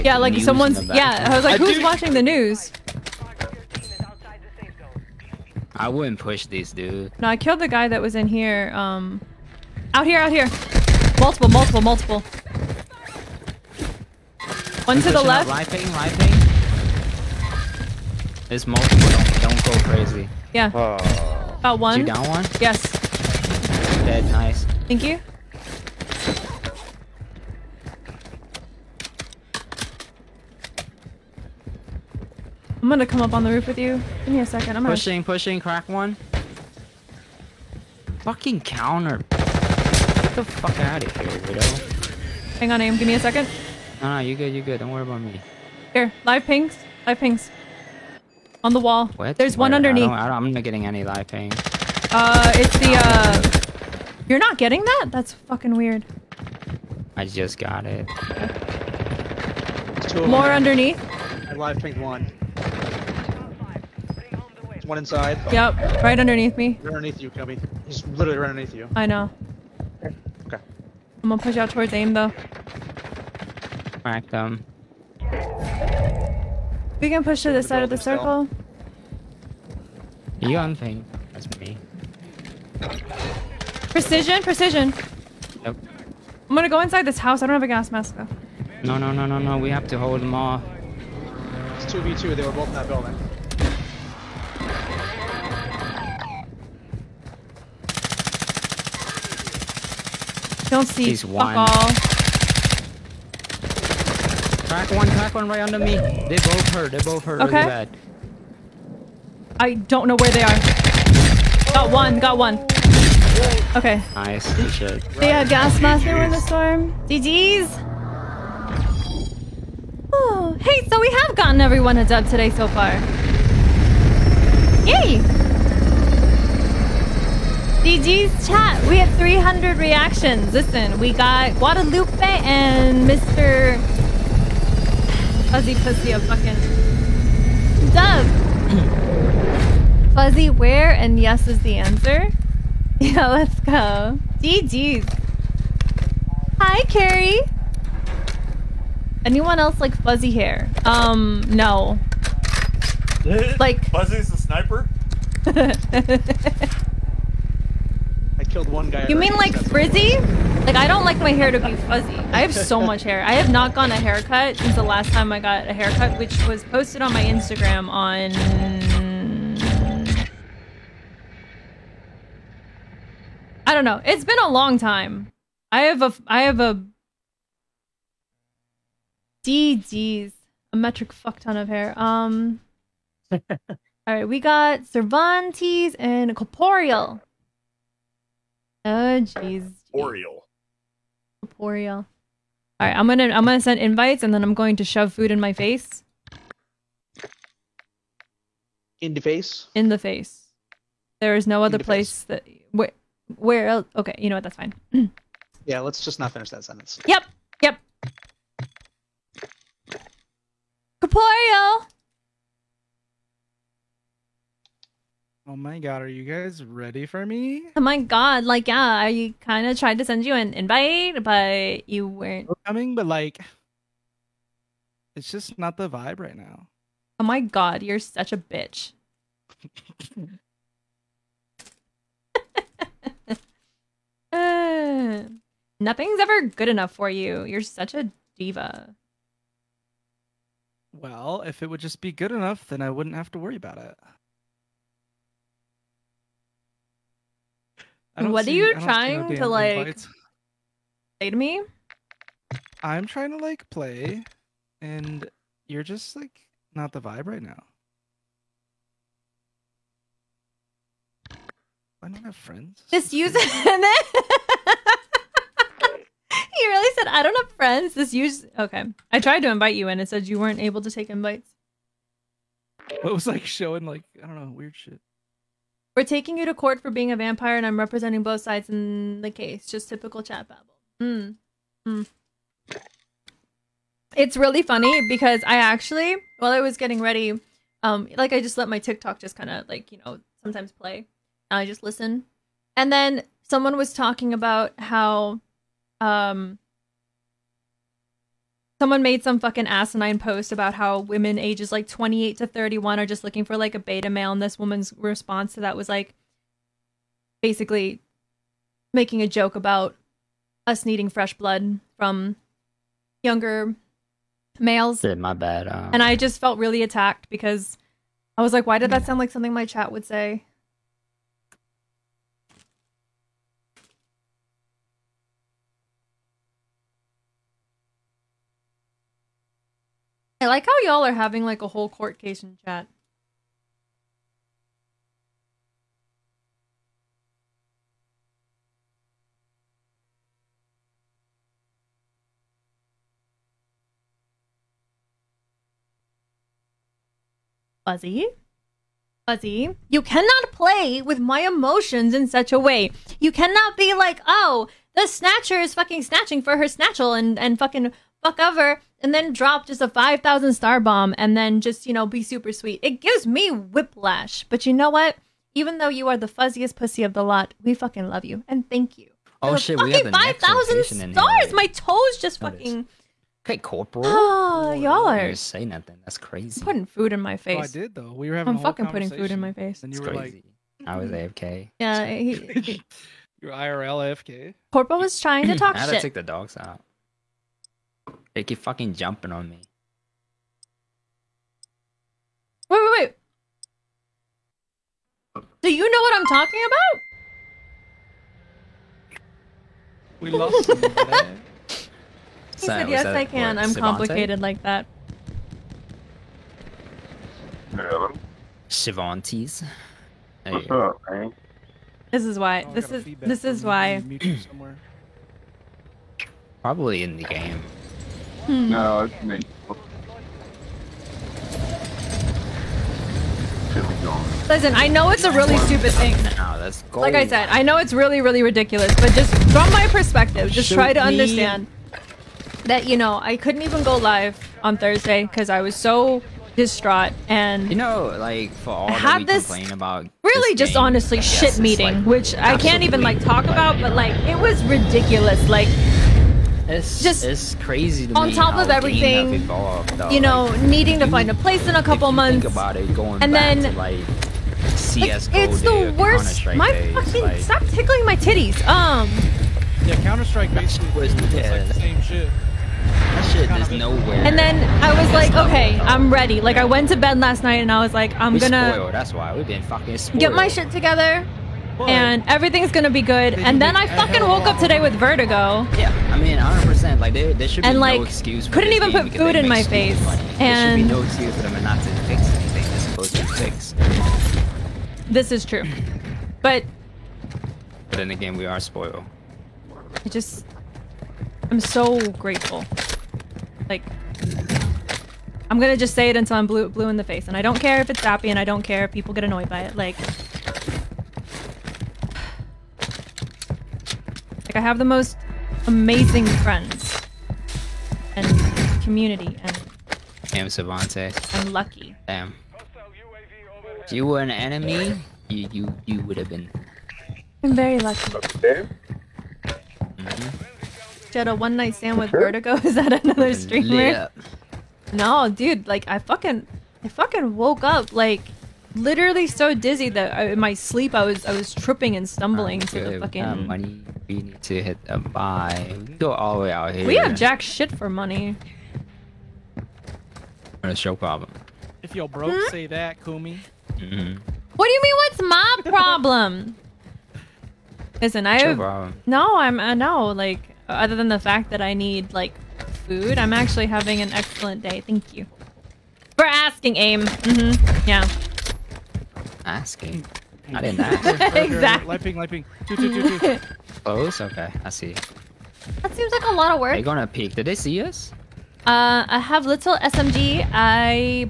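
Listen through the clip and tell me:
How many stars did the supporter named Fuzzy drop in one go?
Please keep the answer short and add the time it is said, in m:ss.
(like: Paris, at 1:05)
5,000, at 5:59.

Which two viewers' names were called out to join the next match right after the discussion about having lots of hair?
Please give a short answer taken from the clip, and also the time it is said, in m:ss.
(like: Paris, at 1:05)
Cervantes and Corporeal, at 3:04.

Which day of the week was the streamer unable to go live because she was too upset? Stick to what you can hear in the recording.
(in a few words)
Thursday.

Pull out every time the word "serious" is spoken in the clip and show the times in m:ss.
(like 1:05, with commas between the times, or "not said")
not said.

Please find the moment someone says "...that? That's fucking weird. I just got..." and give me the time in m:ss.
0:54.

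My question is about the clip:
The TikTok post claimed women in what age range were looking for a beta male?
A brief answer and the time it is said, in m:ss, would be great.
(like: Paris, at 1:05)
28 to 31, at 5:01.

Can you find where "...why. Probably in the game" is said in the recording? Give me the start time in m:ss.
6:53.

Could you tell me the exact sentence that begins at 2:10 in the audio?
Listen, we got Guadalupe and Mr.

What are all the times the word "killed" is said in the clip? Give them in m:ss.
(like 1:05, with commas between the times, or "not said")
0:07, 2:38.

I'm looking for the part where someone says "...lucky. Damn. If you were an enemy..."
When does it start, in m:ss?
8:31.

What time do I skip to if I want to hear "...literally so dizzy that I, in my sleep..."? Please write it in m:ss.
8:48.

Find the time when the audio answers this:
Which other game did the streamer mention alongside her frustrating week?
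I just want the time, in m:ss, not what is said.
7:34.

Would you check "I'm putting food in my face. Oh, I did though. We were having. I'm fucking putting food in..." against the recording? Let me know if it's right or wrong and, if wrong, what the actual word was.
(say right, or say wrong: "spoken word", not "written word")
right.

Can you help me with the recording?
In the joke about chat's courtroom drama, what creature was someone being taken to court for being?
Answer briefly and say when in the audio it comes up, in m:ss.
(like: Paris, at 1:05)
A vampire, at 4:37.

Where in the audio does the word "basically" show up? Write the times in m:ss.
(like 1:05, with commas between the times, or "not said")
5:07, 7:40.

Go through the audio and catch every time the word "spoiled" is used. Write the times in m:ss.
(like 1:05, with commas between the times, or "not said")
7:48, 8:08.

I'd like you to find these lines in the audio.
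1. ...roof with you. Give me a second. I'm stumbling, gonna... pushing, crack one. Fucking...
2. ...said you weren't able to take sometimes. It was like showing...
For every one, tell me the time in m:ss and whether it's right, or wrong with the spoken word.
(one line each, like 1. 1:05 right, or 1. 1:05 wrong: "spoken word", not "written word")
1. 0:33 wrong: "pushing", not "stumbling"
2. 4:30 wrong: "invites", not "sometimes".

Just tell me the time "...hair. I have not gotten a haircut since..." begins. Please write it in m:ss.
2:43.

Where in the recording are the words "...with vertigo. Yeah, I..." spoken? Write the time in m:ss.
7:54.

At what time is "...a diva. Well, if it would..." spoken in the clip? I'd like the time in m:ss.
3:57.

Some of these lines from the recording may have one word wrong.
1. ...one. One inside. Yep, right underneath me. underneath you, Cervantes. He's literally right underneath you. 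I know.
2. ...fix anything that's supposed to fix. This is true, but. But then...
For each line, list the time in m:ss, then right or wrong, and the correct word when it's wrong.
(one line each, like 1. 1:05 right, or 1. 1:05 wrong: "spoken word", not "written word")
1. 1:02 wrong: "Cubby", not "Cervantes"
2. 8:02 right.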